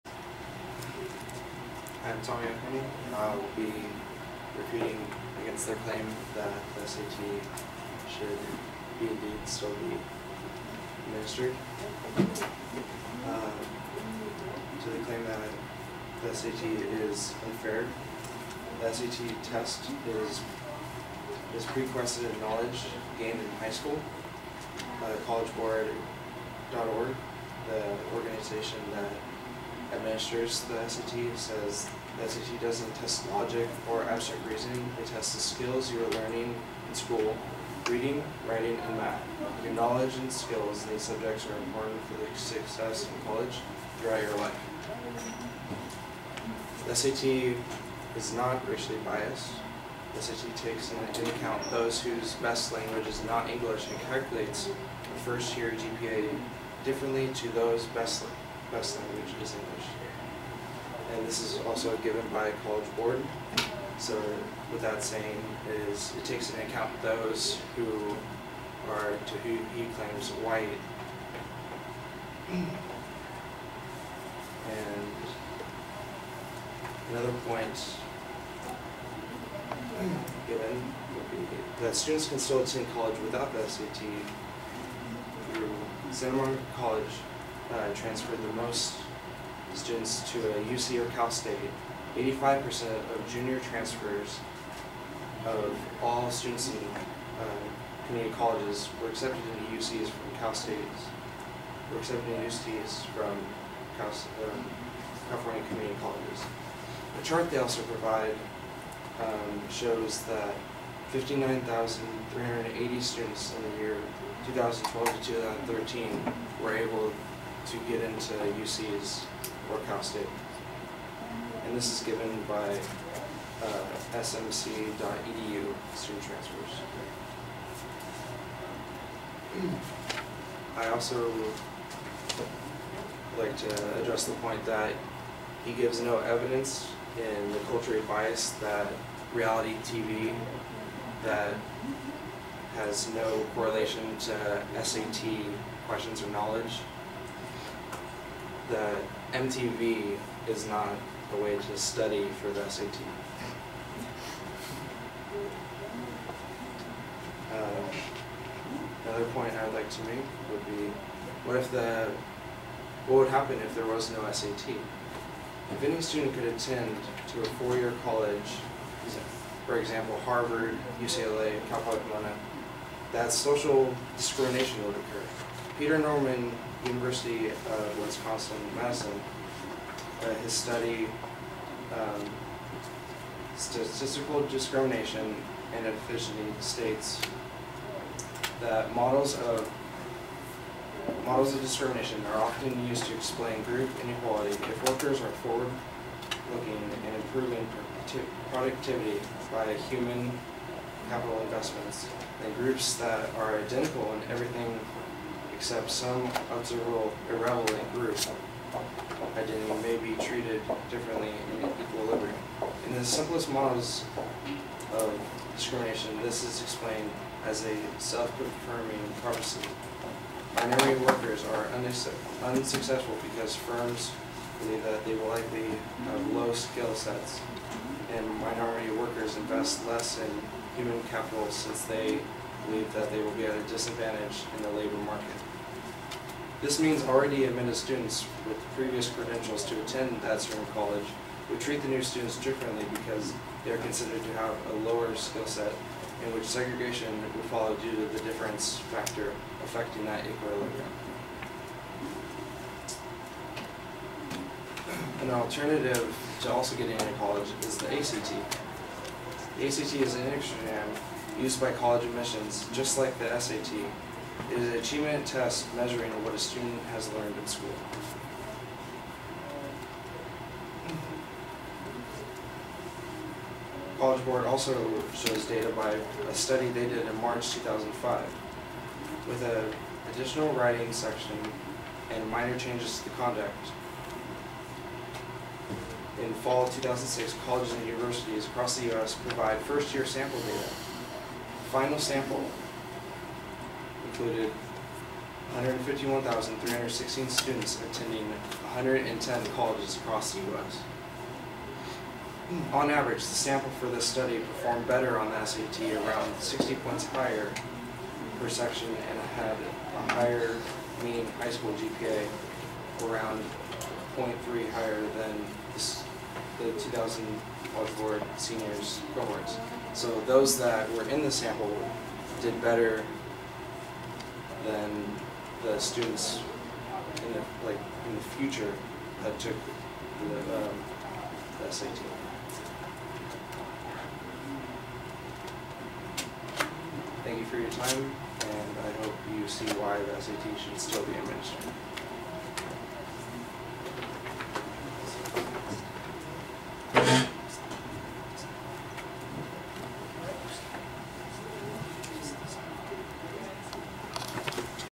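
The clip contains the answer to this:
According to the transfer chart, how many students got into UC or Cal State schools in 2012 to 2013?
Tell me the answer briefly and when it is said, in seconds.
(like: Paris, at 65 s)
59,380, at 111 s.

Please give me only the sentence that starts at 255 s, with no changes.
An alternative to also getting into college is the ACT.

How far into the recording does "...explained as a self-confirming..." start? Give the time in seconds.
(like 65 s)
216 s.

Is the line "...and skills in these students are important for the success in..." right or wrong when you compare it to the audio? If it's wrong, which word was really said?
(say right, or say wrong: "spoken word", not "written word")
wrong: "subjects", not "students".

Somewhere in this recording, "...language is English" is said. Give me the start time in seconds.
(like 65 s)
58 s.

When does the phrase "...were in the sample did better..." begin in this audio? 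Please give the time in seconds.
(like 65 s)
320 s.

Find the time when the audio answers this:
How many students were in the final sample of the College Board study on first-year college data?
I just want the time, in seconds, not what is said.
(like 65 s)
295 s.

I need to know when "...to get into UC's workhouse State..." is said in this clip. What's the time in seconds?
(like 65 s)
117 s.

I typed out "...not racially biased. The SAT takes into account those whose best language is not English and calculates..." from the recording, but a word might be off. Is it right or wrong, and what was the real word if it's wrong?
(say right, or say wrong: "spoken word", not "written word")
right.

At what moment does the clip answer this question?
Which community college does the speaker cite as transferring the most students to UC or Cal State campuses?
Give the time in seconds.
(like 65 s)
86 s.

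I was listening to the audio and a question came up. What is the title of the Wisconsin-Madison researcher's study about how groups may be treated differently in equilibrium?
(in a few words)
Statistical Discrimination and Efficiency.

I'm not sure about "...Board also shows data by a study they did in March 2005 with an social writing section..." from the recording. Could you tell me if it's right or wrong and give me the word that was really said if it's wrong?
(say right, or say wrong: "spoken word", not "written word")
wrong: "additional", not "social".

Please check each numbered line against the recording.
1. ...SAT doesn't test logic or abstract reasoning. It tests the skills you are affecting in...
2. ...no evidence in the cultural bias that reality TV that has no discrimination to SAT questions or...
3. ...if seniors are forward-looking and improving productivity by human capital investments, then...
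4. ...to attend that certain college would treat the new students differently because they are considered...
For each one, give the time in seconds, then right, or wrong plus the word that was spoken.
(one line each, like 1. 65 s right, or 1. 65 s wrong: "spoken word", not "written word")
1. 32 s wrong: "learning", not "affecting"
2. 136 s wrong: "correlation", not "discrimination"
3. 194 s wrong: "workers", not "seniors"
4. 239 s right.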